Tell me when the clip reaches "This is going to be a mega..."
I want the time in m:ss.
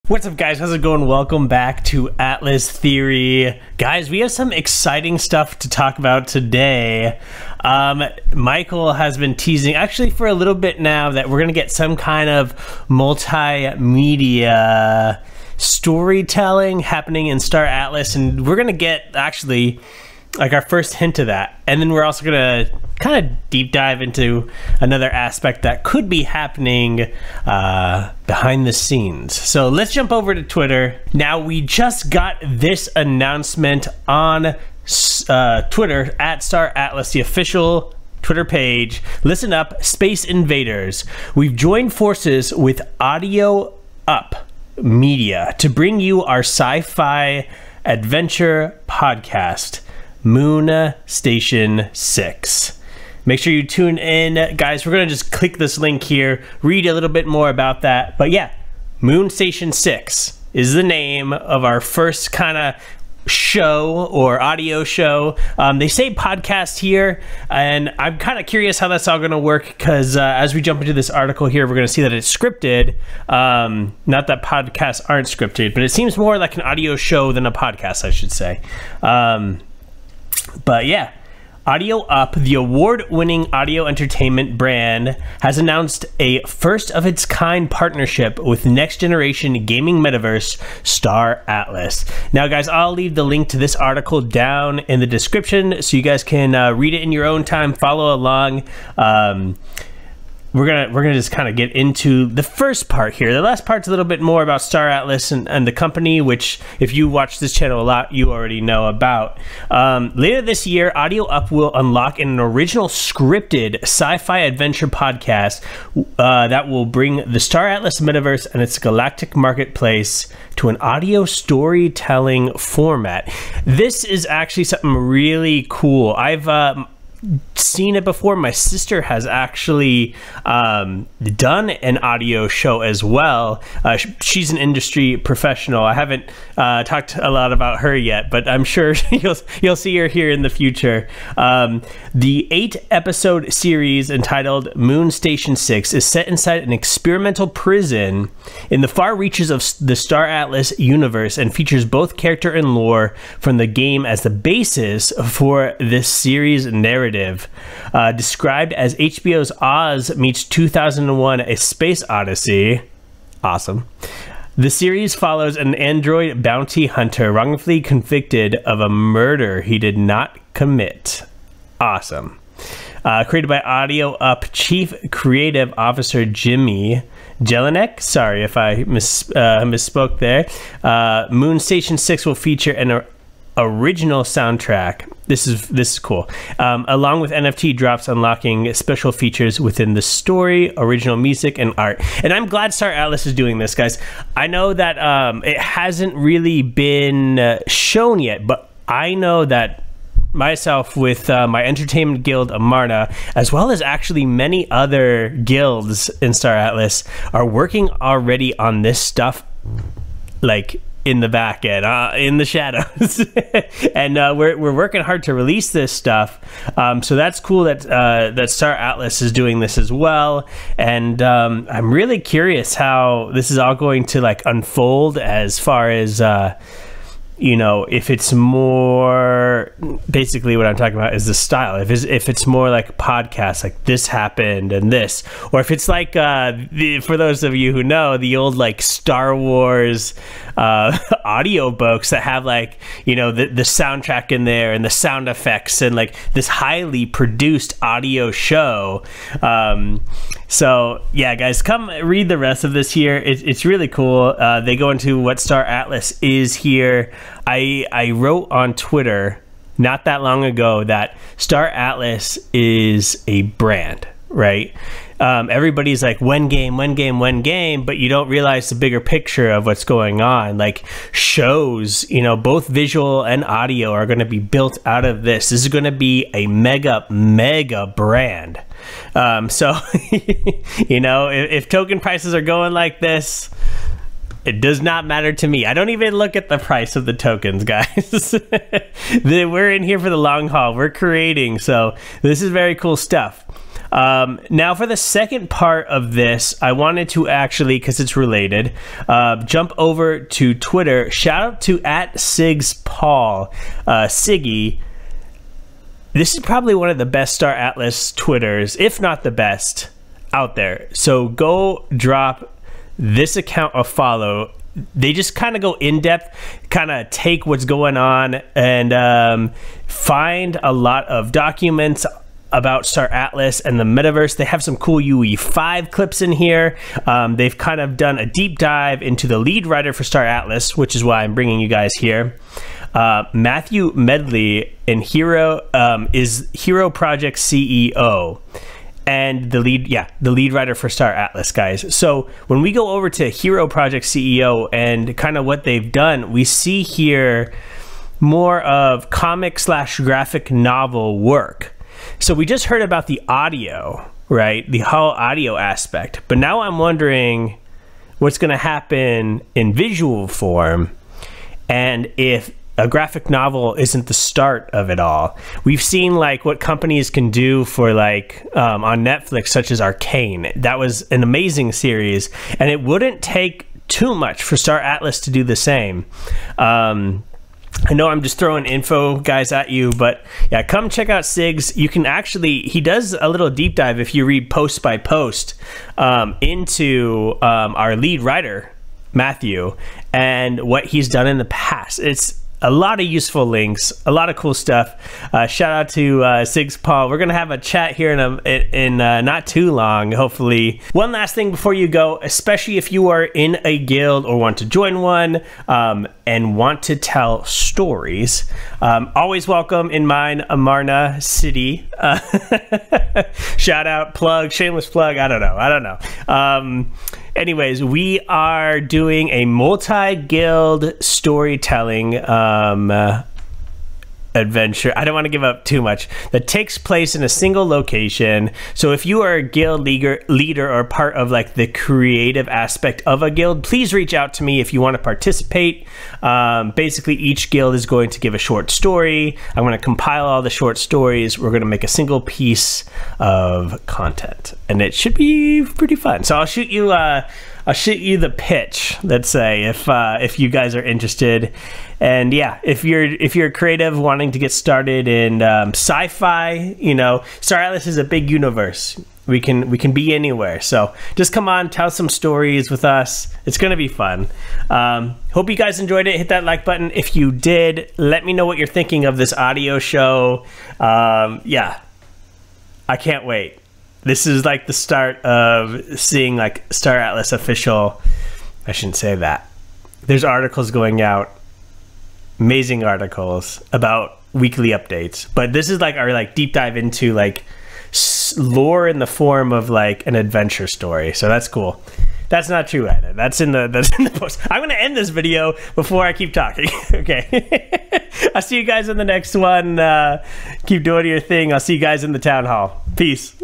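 4:35.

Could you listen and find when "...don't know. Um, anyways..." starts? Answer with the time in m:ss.
6:55.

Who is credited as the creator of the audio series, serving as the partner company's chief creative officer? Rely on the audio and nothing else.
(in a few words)
Jimmy Jellinek.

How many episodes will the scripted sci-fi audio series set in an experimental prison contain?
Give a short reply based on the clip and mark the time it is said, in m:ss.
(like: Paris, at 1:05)
8, at 2:22.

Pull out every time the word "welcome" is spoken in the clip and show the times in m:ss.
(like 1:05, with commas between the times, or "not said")
0:01, 6:49.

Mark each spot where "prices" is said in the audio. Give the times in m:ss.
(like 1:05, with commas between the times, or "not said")
4:41, 4:46.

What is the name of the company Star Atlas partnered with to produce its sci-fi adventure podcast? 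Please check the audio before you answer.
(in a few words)
Audio Up Media.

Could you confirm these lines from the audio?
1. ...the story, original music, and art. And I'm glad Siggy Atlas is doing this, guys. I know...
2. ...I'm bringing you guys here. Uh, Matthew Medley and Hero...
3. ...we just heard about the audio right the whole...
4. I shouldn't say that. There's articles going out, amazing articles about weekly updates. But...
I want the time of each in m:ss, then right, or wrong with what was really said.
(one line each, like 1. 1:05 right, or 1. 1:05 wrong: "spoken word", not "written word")
1. 3:09 wrong: "Star", not "Siggy"
2. 5:31 right
3. 5:52 right
4. 7:58 right.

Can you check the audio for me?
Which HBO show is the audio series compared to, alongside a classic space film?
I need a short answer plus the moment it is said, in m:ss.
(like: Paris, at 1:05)
Oz, at 2:39.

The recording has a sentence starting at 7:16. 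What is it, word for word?
Um, basically, each guild is going to give a short story.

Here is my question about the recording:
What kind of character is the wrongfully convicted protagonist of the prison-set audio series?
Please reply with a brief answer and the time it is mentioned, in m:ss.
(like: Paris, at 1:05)
Android bounty hunter, at 2:45.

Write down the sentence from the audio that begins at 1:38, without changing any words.
Um, we're gonna we're gonna just kind of get into the first part here.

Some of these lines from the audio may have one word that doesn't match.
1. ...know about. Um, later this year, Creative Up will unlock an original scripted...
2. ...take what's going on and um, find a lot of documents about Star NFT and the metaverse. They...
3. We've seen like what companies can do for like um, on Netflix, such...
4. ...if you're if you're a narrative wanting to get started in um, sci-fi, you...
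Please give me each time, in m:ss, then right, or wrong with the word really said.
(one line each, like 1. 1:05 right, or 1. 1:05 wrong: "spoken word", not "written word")
1. 1:48 wrong: "Audio", not "Creative"
2. 5:17 wrong: "Atlas", not "NFT"
3. 6:05 right
4. 7:32 wrong: "creative", not "narrative".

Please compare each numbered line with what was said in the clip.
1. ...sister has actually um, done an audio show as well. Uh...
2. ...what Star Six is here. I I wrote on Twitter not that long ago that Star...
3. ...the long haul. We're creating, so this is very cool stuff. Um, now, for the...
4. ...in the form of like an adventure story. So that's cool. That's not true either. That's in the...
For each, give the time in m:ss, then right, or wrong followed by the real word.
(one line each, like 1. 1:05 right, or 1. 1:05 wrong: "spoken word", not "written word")
1. 2:08 right
2. 4:15 wrong: "Atlas", not "Six"
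3. 4:50 right
4. 8:08 right.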